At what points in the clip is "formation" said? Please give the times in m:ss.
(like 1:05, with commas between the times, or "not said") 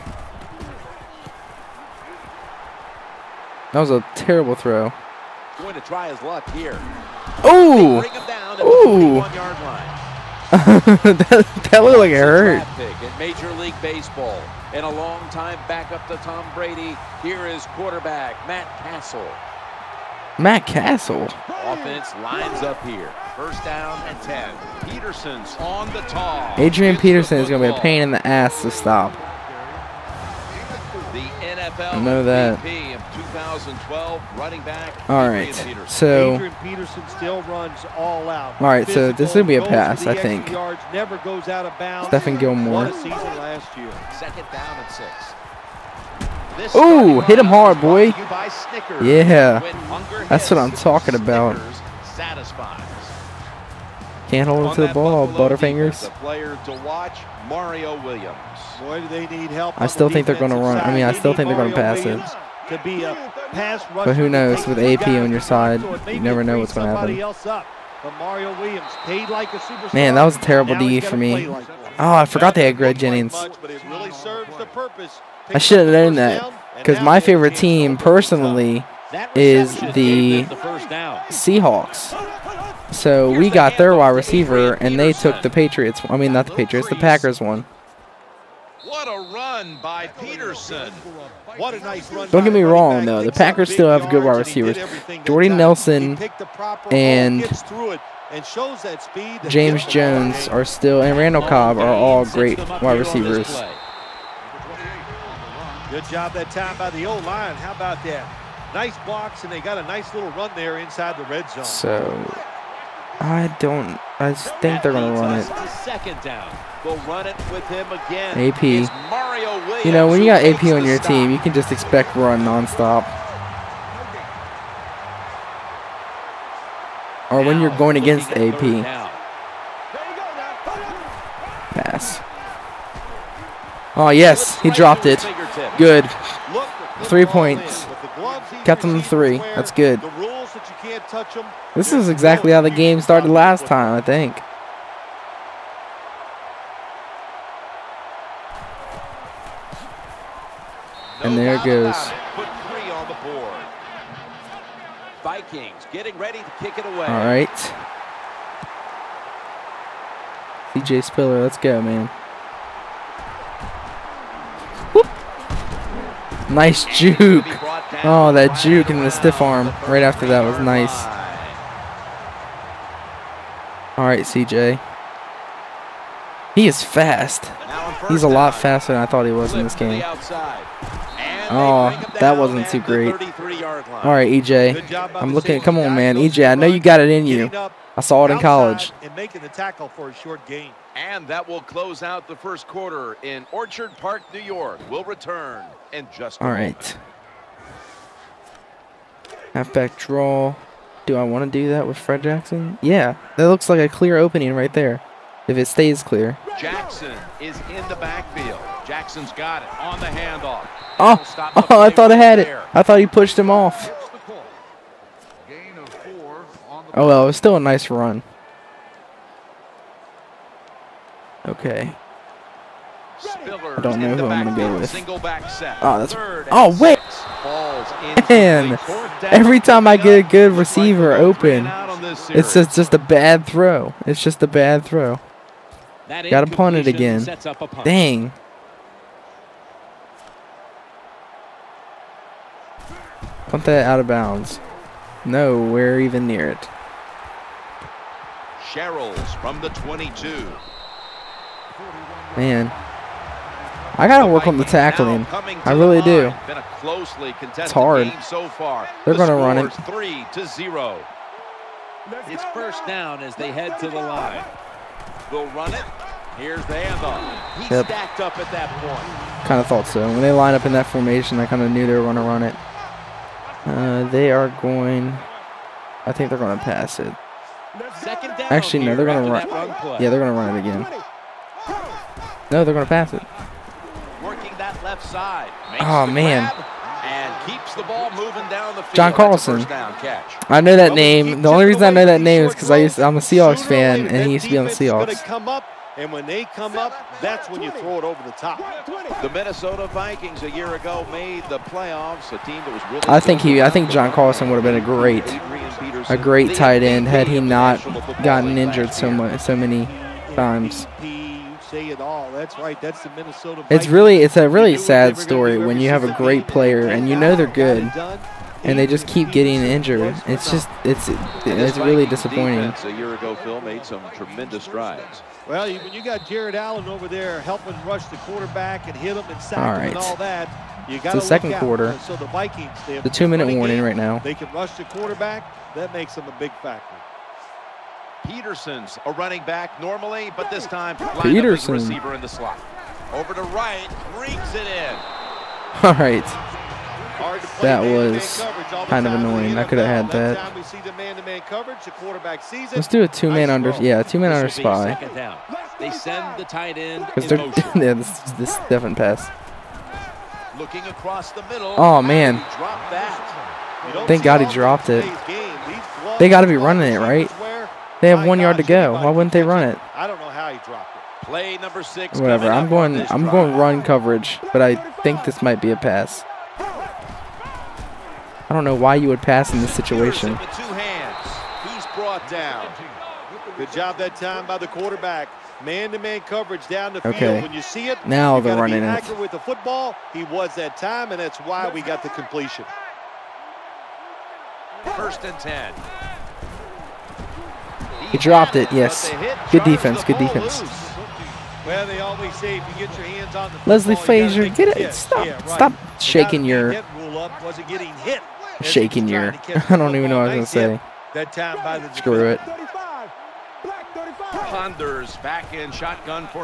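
4:30.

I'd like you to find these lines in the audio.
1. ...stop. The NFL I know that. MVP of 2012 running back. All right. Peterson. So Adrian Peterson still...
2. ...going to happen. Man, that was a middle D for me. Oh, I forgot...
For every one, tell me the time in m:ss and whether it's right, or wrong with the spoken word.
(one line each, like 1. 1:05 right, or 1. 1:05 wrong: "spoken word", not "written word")
1. 0:28 right
2. 1:06 wrong: "terrible", not "middle".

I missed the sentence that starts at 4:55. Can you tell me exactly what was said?
And when they come up, that's when you throw it over the top.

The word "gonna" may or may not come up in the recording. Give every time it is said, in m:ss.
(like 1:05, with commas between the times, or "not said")
1:54, 3:44, 4:19, 6:50.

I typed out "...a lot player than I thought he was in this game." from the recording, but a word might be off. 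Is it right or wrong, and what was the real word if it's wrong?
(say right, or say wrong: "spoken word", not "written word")
wrong: "faster", not "player".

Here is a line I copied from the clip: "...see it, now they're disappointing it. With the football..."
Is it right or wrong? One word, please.
wrong.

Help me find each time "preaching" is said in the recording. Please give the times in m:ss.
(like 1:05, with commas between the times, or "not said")
not said.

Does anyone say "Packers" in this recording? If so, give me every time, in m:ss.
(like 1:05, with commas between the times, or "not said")
1:26, 1:33.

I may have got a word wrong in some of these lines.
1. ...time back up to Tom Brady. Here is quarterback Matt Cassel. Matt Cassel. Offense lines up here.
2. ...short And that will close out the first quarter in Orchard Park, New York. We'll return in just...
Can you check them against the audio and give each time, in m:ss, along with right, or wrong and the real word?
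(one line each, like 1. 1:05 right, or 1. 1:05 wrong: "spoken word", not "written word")
1. 0:15 right
2. 3:10 right.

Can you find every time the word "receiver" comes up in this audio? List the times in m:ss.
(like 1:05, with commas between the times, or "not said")
1:24, 1:34, 1:43, 3:50, 5:41.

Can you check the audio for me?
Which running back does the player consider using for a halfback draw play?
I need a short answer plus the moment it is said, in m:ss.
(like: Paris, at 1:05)
Fred Jackson, at 3:21.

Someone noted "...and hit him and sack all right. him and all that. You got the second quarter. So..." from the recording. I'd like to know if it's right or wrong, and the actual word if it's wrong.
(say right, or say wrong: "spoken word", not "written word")
right.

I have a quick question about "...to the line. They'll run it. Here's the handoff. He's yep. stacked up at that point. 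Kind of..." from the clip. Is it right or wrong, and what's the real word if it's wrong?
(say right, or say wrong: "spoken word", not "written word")
right.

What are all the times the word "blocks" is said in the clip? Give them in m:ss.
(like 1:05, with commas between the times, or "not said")
1:49.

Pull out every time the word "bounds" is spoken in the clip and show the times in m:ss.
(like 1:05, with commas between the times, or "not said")
0:41, 4:04.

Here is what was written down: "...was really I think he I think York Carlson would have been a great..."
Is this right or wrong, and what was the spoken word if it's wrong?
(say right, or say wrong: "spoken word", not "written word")
wrong: "John", not "York".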